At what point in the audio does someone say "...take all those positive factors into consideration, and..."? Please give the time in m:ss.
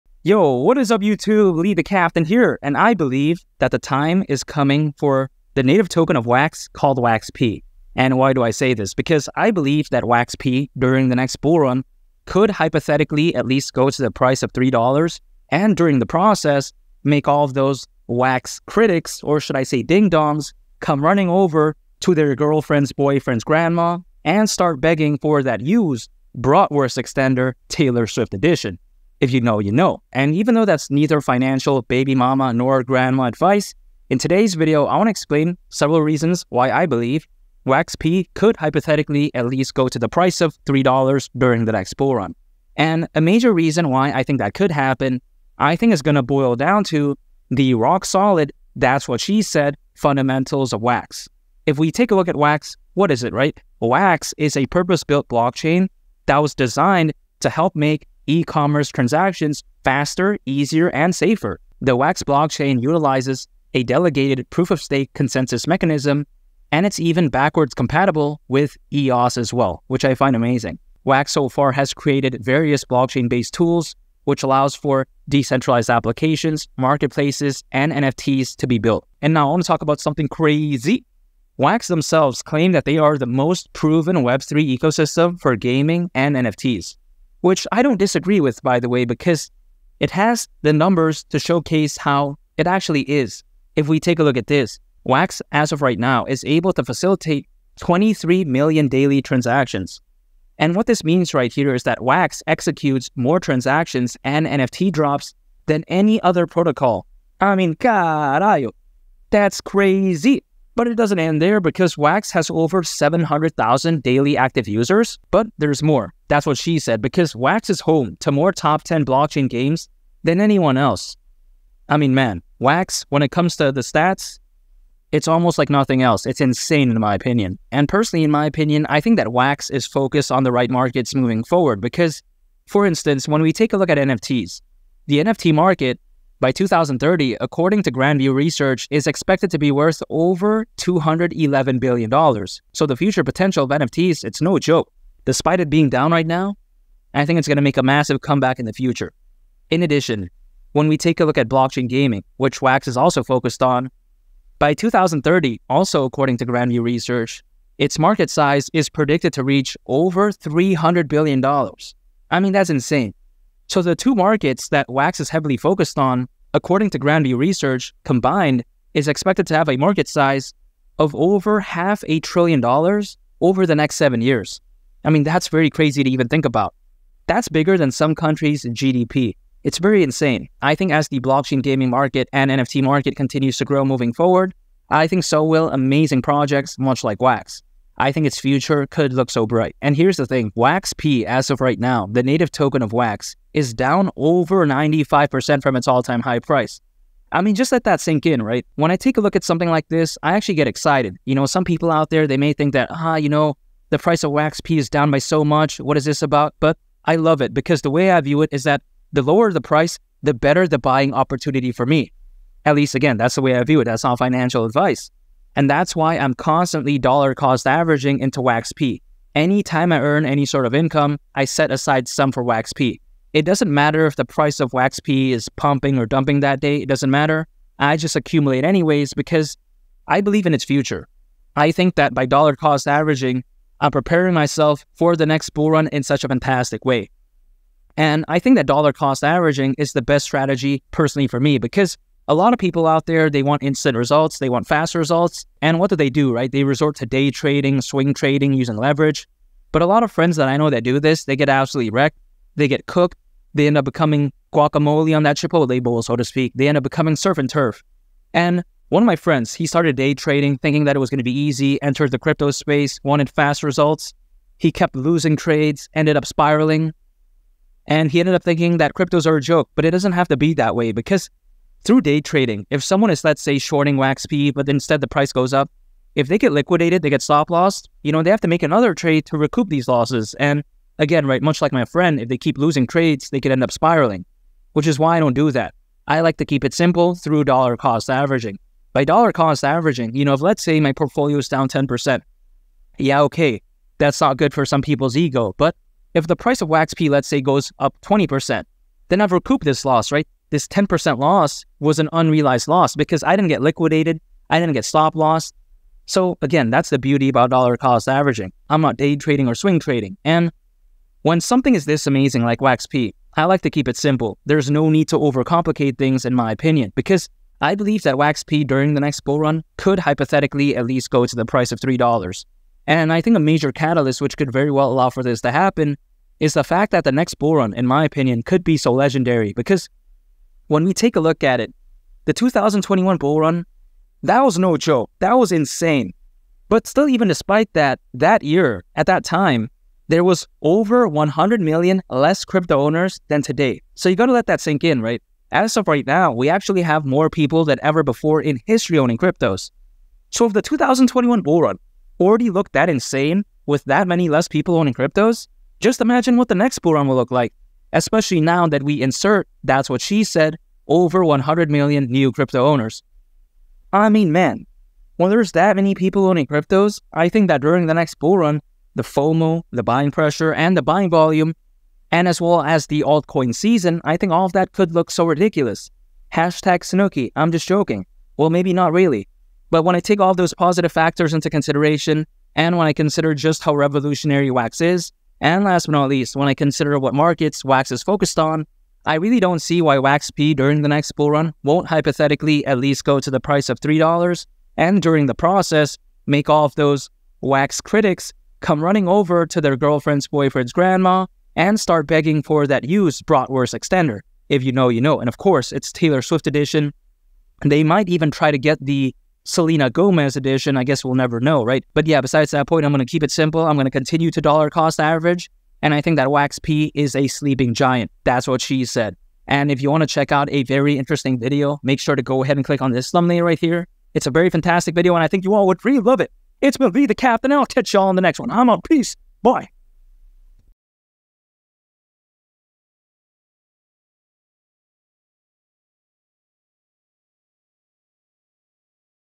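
6:20.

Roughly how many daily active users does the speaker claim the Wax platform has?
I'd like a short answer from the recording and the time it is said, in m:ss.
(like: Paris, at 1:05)
Over 700,000, at 1:52.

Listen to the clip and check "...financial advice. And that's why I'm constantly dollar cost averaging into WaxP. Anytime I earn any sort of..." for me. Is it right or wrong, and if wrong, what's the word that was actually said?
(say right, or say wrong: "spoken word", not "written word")
right.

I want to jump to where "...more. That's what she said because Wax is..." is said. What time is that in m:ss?
1:55.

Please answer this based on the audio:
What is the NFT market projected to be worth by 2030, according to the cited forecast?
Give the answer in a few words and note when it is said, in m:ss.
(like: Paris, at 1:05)
Over $211 billion, at 2:20.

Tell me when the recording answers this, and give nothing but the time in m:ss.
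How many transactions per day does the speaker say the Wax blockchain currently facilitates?
1:37.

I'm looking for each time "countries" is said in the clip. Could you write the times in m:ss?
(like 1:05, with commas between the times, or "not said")
2:58.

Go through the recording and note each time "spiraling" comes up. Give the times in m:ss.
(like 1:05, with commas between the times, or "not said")
4:26, 4:43.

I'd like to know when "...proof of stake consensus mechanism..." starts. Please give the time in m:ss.
1:04.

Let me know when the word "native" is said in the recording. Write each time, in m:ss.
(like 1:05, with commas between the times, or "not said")
0:05, 3:12.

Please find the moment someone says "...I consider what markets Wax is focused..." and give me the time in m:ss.
6:26.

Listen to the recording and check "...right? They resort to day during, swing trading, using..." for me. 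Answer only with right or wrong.
wrong.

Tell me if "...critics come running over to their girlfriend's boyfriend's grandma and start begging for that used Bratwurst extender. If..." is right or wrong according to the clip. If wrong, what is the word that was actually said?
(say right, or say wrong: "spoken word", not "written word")
right.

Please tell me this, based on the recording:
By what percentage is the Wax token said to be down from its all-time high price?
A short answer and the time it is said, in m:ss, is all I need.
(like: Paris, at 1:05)
Over 95%, at 3:14.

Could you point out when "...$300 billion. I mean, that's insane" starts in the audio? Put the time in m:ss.
2:40.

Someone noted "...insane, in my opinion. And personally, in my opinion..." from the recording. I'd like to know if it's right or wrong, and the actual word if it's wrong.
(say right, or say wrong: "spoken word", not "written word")
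right.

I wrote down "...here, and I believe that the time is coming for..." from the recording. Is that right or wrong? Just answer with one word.
right.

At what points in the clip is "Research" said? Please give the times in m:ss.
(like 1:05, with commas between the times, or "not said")
2:18, 2:36, 2:47.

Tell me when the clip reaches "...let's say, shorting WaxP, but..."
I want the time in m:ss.
4:33.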